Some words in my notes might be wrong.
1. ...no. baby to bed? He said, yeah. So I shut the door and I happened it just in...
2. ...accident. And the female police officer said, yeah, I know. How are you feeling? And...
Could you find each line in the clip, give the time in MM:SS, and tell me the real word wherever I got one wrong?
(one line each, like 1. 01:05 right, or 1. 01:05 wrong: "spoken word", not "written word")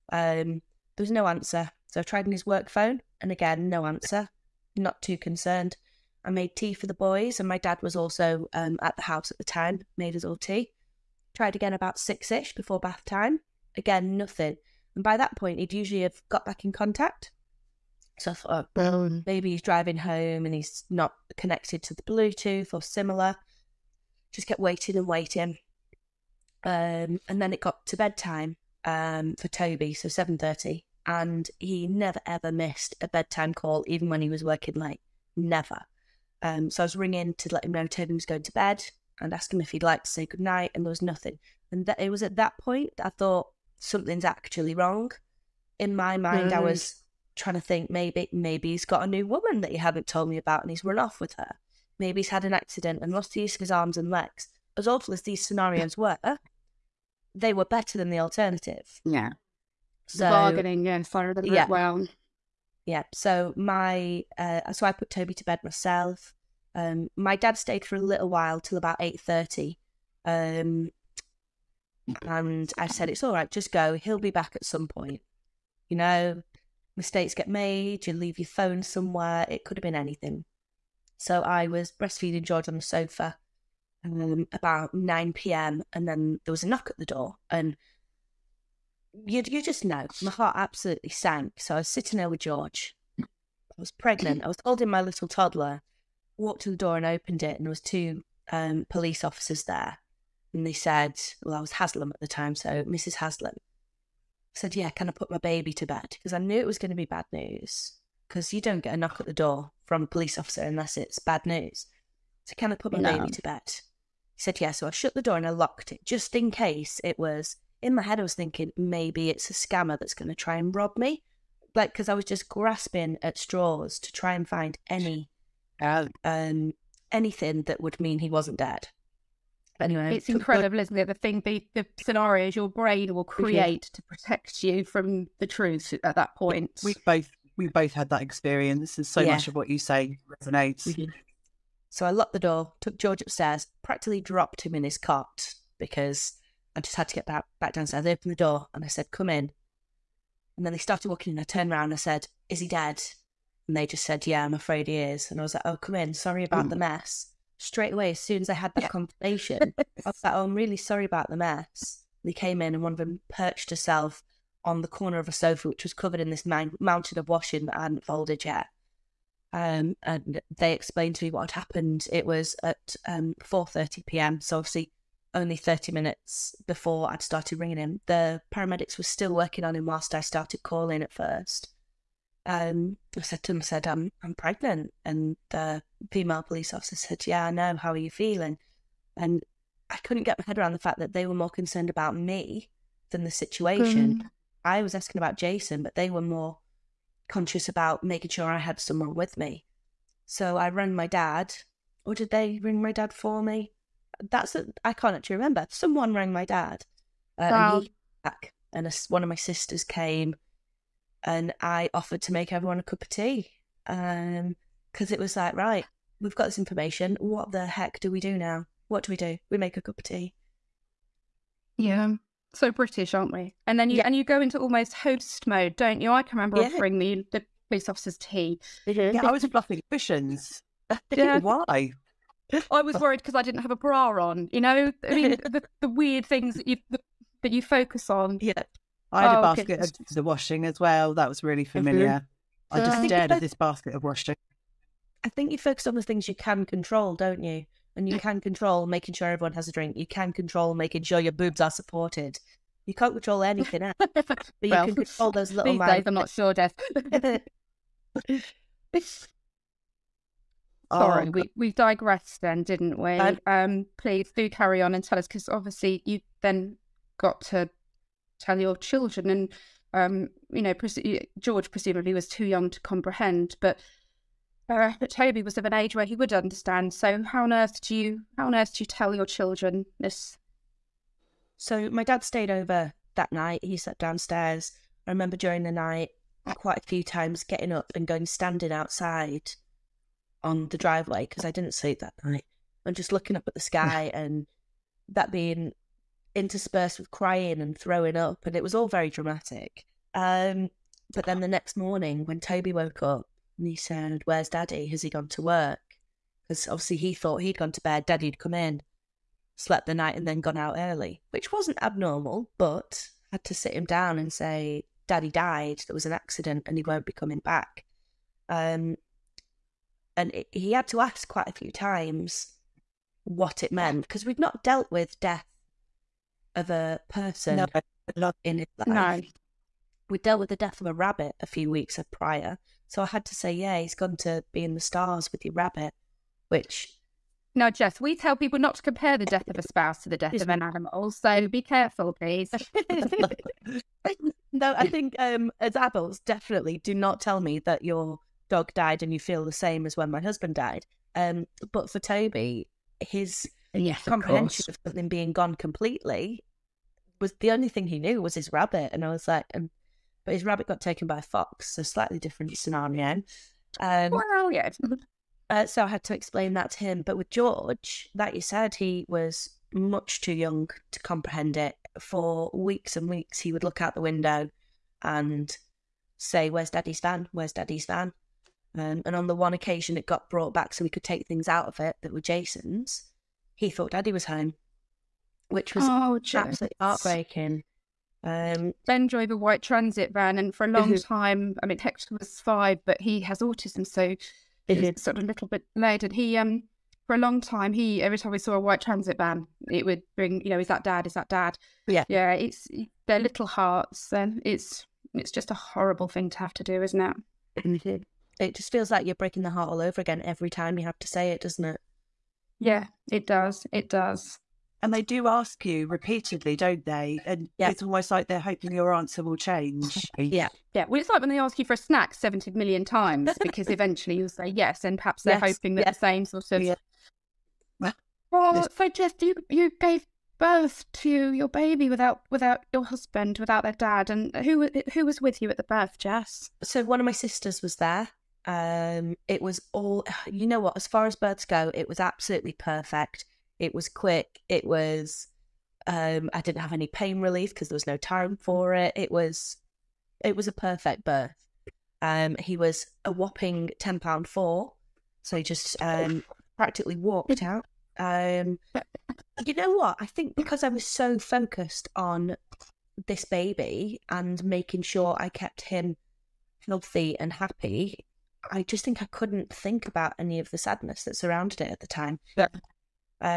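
1. 01:52 wrong: "locked", not "happened"
2. 03:04 wrong: "pregnant", not "accident".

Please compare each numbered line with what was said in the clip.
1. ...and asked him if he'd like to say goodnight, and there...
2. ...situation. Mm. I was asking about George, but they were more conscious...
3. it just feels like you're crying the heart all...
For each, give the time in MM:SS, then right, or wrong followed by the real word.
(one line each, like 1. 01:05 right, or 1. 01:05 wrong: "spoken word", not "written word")
1. 00:39 right
2. 03:13 wrong: "Jason", not "George"
3. 06:48 wrong: "breaking", not "crying".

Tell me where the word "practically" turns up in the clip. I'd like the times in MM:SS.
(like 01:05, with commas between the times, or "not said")
02:23, 07:36.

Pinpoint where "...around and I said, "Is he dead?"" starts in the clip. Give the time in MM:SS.
02:31.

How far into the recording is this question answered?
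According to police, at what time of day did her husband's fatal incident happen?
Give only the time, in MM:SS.
02:53.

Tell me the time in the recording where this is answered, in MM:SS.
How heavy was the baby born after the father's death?
07:33.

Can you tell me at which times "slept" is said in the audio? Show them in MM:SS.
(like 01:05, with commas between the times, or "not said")
04:43, 05:09.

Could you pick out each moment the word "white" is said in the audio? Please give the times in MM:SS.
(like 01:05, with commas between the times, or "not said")
06:29, 06:38.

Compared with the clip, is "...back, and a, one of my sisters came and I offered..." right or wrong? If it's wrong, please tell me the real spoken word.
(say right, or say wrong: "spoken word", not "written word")
right.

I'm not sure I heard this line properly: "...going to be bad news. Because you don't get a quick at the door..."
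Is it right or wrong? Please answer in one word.
wrong.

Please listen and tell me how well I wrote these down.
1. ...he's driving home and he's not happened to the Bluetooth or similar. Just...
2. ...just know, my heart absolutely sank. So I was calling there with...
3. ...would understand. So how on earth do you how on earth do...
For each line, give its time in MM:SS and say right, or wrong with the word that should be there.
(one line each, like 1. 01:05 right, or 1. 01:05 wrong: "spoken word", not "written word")
1. 00:19 wrong: "connected", not "happened"
2. 01:29 wrong: "sitting", not "calling"
3. 04:36 right.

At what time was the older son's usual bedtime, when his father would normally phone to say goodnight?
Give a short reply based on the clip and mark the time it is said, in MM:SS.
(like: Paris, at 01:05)
7.30, at 00:30.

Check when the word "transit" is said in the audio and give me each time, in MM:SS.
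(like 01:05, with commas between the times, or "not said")
06:29, 06:38.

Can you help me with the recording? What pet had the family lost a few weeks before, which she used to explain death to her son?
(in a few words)
A rabbit.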